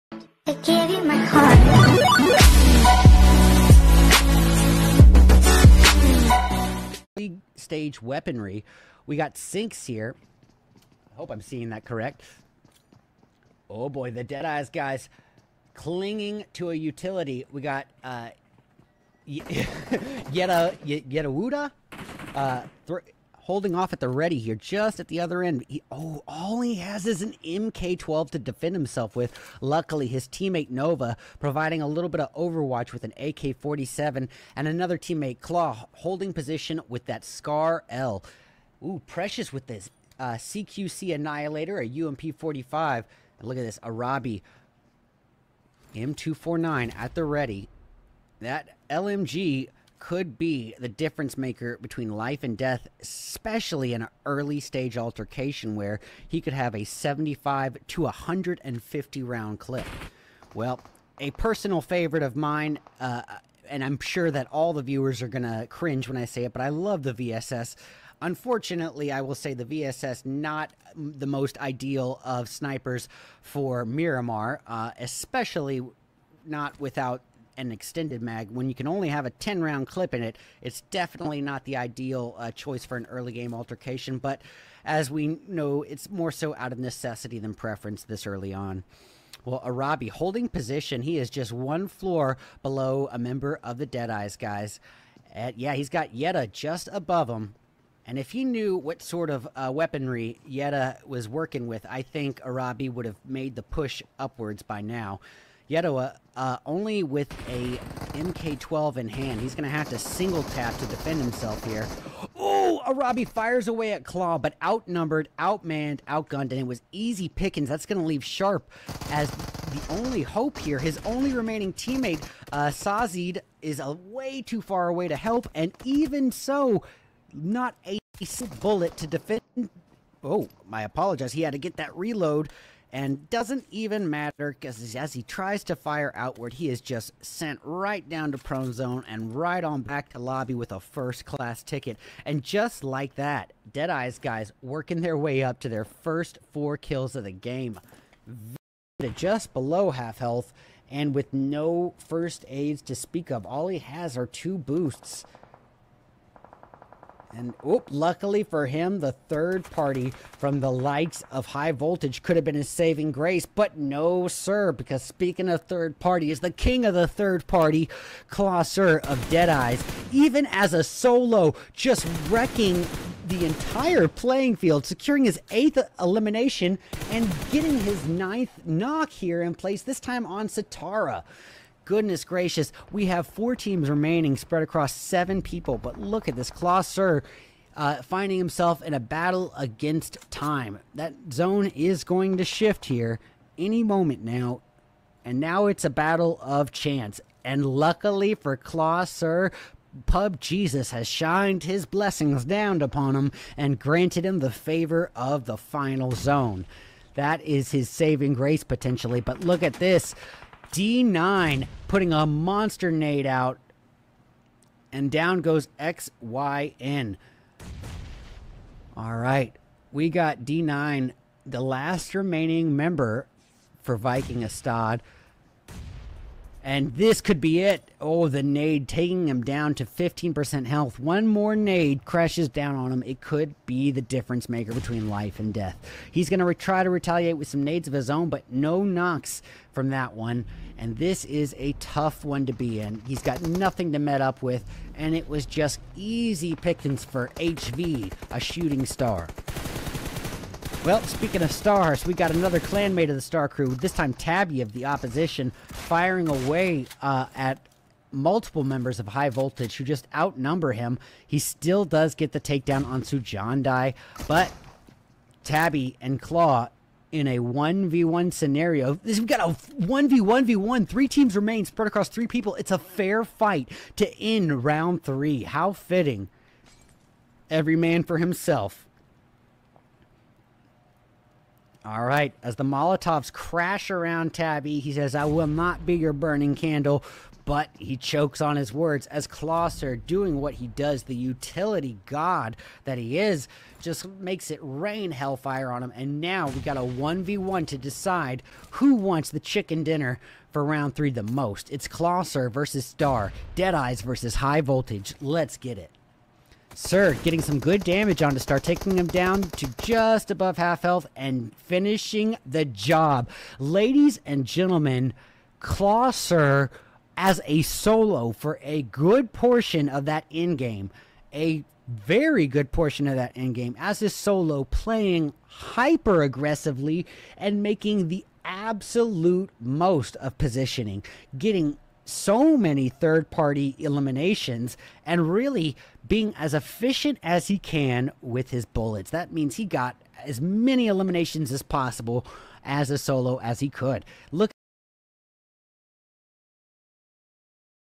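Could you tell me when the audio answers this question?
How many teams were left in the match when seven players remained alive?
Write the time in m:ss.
3:03.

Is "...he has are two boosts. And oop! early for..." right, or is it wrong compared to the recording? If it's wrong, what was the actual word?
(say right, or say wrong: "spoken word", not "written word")
wrong: "luckily", not "early".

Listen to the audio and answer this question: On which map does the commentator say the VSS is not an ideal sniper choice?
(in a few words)
Miramar.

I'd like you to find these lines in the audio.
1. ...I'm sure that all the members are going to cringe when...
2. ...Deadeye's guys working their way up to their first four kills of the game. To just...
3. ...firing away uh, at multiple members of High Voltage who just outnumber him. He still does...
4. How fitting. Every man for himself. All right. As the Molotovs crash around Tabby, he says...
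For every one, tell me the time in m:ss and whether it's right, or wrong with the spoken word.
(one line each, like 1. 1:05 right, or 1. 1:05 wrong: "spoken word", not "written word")
1. 1:03 wrong: "viewers", not "members"
2. 2:23 right
3. 4:15 right
4. 4:35 right.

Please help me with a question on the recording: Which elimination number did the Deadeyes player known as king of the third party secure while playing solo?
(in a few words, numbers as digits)
eighth.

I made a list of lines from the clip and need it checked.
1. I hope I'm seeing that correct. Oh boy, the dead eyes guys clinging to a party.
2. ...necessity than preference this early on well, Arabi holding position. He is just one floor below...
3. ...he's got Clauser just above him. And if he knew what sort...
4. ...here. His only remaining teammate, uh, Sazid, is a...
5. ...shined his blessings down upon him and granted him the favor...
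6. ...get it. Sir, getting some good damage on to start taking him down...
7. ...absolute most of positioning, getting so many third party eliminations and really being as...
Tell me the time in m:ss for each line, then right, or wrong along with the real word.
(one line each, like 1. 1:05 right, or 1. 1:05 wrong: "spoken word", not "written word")
1. 0:11 wrong: "utility", not "party"
2. 1:26 right
3. 1:35 wrong: "Yetta", not "Clauser"
4. 2:00 right
5. 3:21 right
6. 5:05 right
7. 5:28 right.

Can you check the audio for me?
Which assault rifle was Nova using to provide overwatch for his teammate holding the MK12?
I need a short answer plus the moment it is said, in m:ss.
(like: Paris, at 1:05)
AK-47, at 0:33.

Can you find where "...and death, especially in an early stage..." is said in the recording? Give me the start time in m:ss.
0:52.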